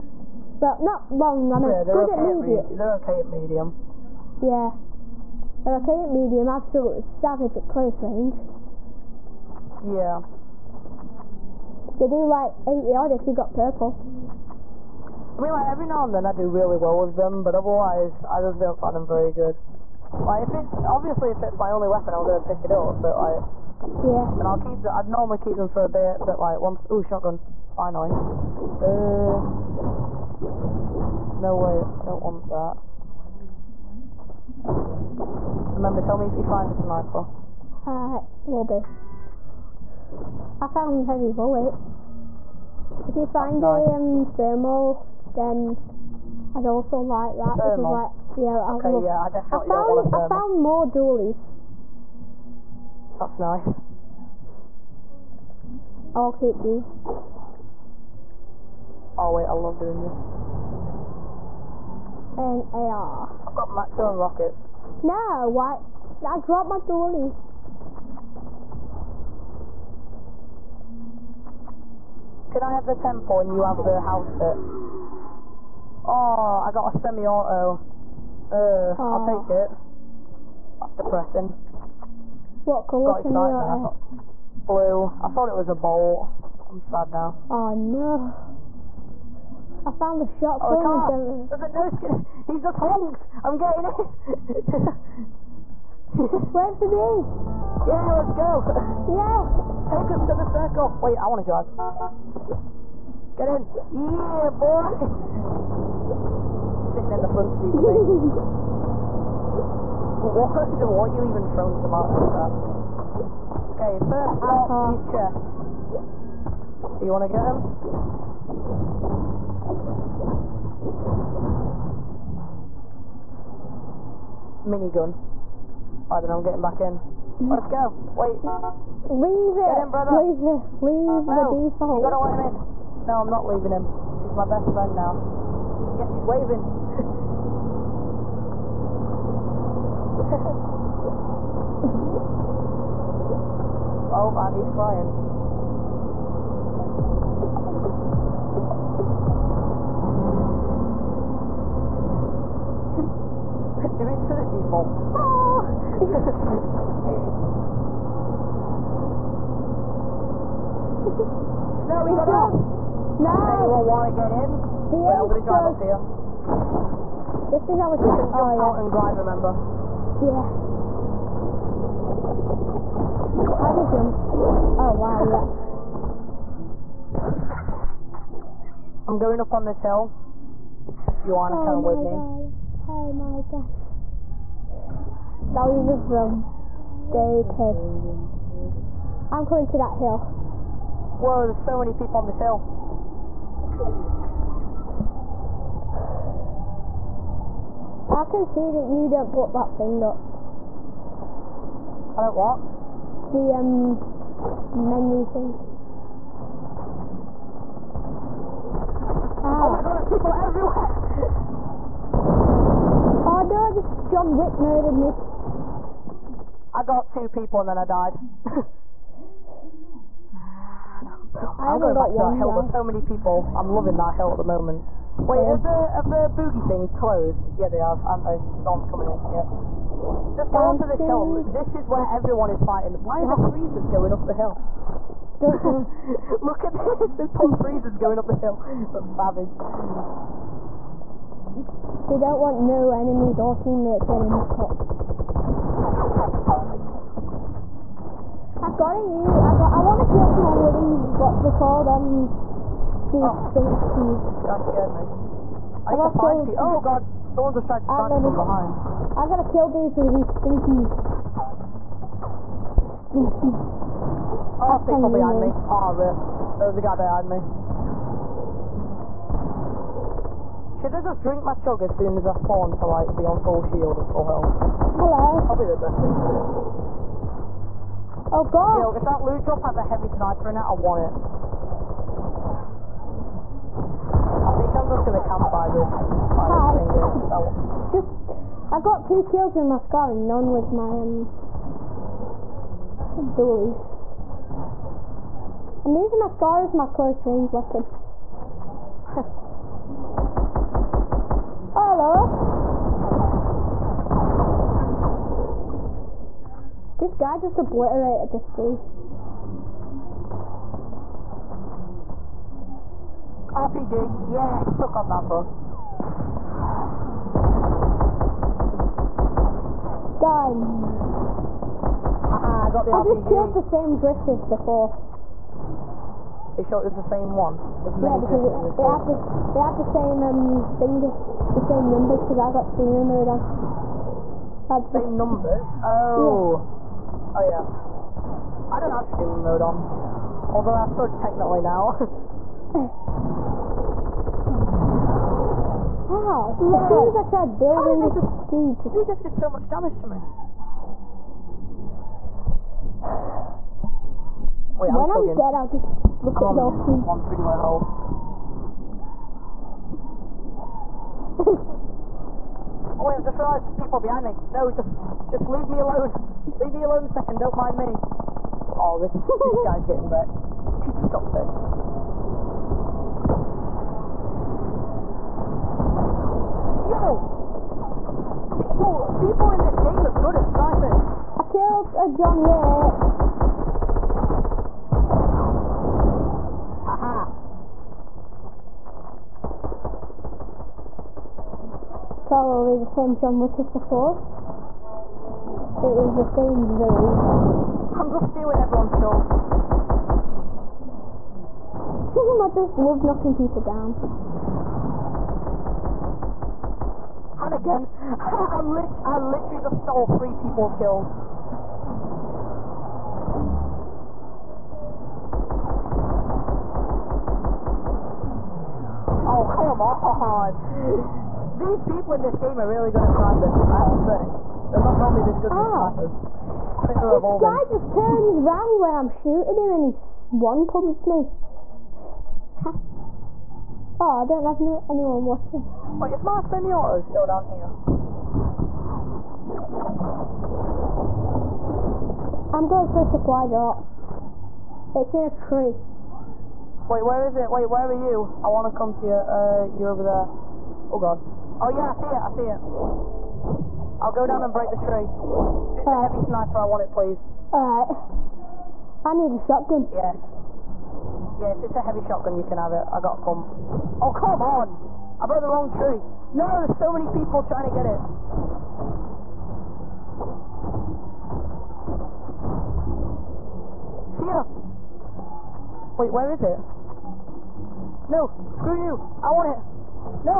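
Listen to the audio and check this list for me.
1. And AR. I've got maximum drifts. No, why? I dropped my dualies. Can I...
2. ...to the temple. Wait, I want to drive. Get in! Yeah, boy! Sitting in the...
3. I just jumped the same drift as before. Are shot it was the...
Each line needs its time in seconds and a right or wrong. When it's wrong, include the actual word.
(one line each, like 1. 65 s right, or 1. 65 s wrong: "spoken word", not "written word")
1. 62 s wrong: "rockets", not "drifts"
2. 100 s wrong: "circle", not "temple"
3. 323 s wrong: "killed", not "jumped".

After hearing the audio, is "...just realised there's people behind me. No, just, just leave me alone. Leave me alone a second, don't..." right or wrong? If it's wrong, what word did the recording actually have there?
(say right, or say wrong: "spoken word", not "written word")
right.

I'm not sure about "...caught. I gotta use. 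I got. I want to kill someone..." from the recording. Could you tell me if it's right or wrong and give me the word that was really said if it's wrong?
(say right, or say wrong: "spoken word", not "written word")
right.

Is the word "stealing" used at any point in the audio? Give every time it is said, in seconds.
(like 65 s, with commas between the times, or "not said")
398 s.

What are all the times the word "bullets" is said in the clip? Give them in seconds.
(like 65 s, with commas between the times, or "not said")
41 s.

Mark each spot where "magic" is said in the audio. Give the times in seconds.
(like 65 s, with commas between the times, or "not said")
not said.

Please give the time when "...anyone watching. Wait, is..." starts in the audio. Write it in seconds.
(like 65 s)
434 s.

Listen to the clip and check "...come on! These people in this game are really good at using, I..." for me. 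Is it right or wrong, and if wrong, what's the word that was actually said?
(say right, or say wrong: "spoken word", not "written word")
wrong: "sniping", not "using".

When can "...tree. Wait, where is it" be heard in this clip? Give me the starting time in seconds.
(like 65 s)
445 s.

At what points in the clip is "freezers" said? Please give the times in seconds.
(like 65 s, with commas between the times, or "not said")
233 s, 237 s.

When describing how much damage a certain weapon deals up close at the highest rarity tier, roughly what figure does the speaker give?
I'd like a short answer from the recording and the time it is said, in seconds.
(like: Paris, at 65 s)
80, at 12 s.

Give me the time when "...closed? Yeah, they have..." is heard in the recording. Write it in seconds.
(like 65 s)
226 s.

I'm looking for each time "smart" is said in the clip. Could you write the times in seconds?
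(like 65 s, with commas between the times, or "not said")
not said.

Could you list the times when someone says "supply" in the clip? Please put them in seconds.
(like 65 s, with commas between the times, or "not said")
443 s.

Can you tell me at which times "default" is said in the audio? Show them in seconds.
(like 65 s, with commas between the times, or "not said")
131 s, 154 s.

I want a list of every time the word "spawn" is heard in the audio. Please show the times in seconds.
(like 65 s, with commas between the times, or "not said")
272 s.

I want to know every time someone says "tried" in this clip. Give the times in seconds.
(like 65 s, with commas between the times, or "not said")
257 s, 347 s.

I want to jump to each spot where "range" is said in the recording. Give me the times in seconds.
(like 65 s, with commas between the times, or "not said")
8 s, 297 s.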